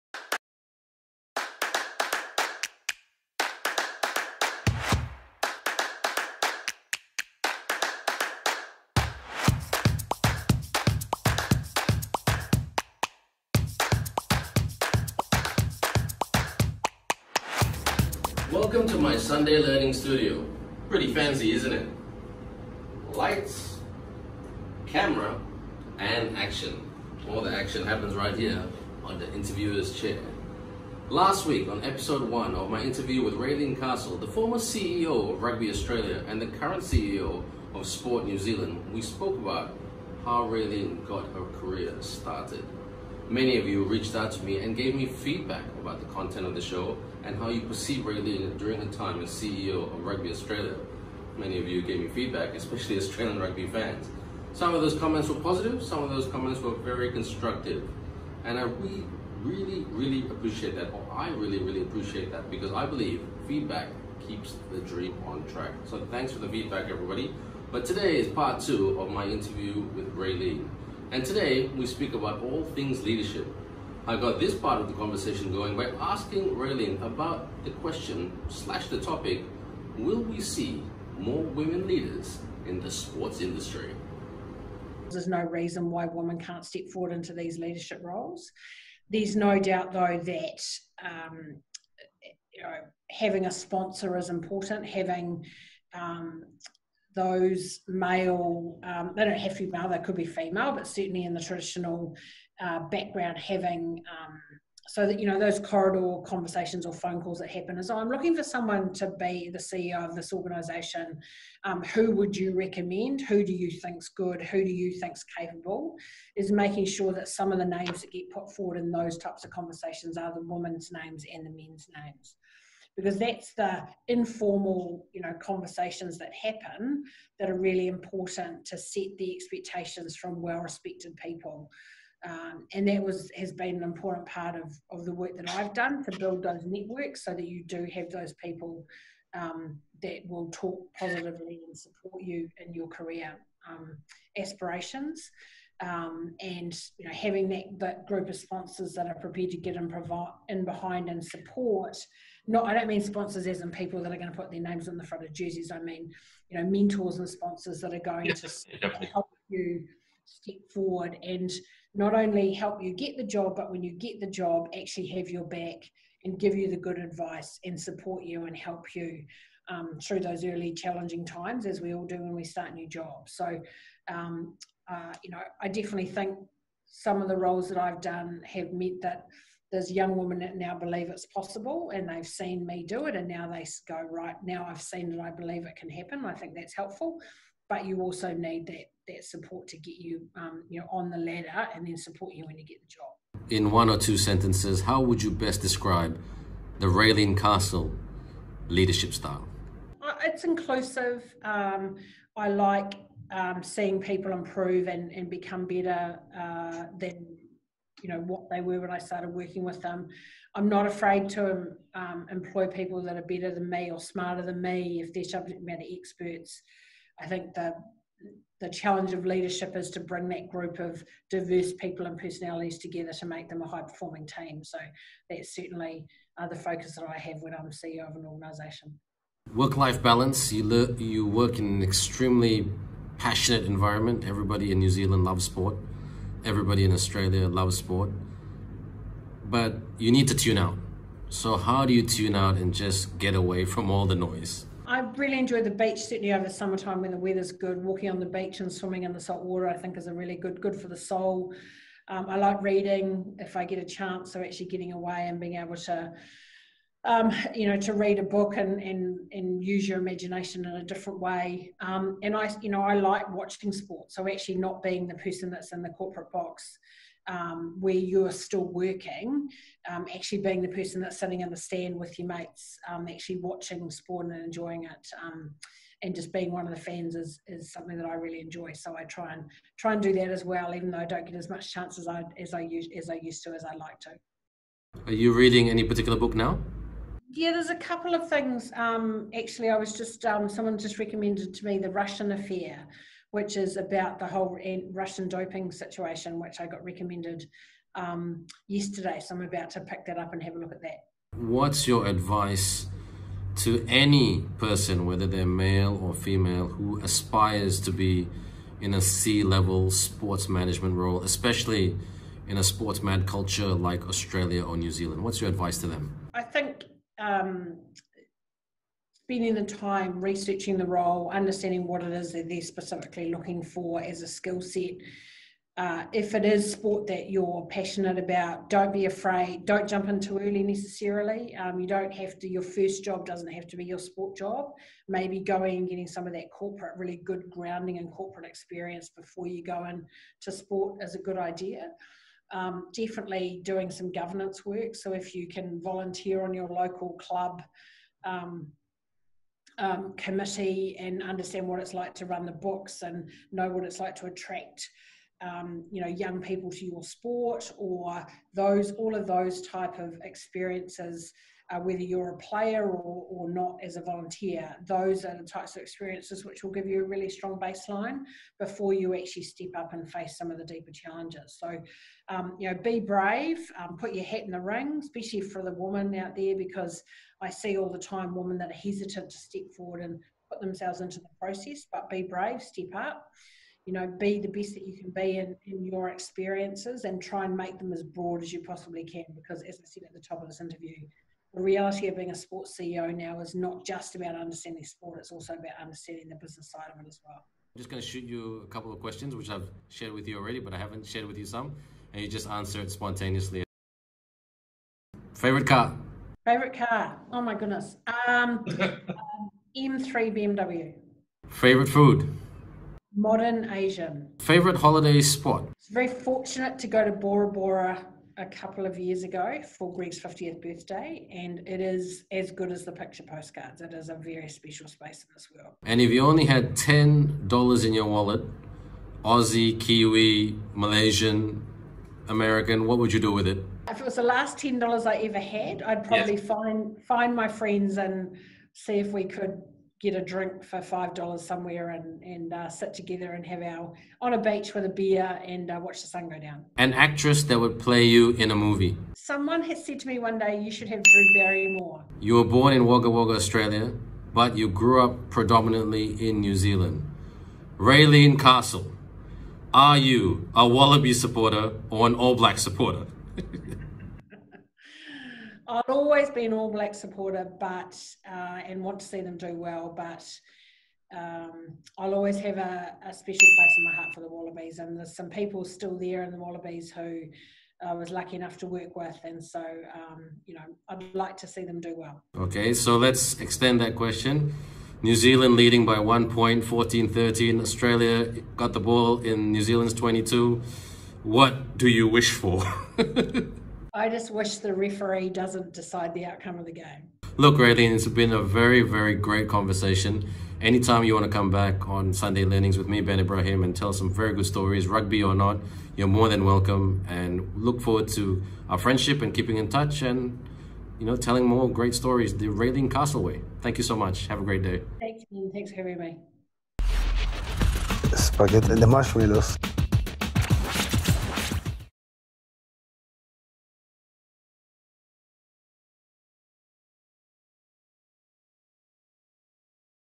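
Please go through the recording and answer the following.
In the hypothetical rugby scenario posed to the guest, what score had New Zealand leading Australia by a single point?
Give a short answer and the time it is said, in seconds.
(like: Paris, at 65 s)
14-13, at 486 s.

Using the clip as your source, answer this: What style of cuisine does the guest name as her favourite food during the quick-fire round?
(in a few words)
Modern Asian.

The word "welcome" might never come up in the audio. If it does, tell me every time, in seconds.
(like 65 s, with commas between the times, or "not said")
18 s, 506 s.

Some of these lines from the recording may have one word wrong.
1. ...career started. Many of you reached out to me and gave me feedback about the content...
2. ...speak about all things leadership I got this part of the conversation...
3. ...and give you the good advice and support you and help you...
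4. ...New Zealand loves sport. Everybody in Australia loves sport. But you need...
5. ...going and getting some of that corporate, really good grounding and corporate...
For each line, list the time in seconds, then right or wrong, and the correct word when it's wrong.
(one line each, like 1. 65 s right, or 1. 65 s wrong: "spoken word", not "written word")
1. 41 s right
2. 71 s right
3. 166 s right
4. 234 s right
5. 335 s right.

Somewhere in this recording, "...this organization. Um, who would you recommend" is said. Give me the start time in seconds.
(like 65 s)
110 s.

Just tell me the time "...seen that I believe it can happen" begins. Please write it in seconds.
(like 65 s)
184 s.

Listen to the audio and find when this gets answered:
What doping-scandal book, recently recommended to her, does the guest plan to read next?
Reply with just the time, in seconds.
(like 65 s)
291 s.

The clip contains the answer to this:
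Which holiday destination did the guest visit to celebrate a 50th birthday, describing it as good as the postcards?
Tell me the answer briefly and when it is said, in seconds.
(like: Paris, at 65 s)
Bora Bora, at 417 s.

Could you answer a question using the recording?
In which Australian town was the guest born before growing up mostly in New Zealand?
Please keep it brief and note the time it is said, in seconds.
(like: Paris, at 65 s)
Wagga Wagga, at 452 s.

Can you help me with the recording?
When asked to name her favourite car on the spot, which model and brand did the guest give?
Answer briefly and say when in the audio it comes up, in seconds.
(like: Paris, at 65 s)
BMW M3, at 408 s.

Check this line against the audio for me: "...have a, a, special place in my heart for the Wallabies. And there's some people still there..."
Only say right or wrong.
right.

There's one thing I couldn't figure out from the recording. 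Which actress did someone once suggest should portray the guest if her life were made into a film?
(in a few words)
Drew Barrymore.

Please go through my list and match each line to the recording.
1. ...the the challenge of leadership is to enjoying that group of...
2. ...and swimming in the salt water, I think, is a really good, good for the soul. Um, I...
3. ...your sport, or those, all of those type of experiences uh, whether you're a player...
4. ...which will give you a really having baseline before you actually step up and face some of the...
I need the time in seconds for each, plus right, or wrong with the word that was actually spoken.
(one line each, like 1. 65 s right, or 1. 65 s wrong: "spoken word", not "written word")
1. 217 s wrong: "bring", not "enjoying"
2. 248 s right
3. 356 s right
4. 366 s wrong: "strong", not "having".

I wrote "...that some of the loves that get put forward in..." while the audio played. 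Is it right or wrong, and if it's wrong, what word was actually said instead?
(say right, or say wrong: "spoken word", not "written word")
wrong: "names", not "loves".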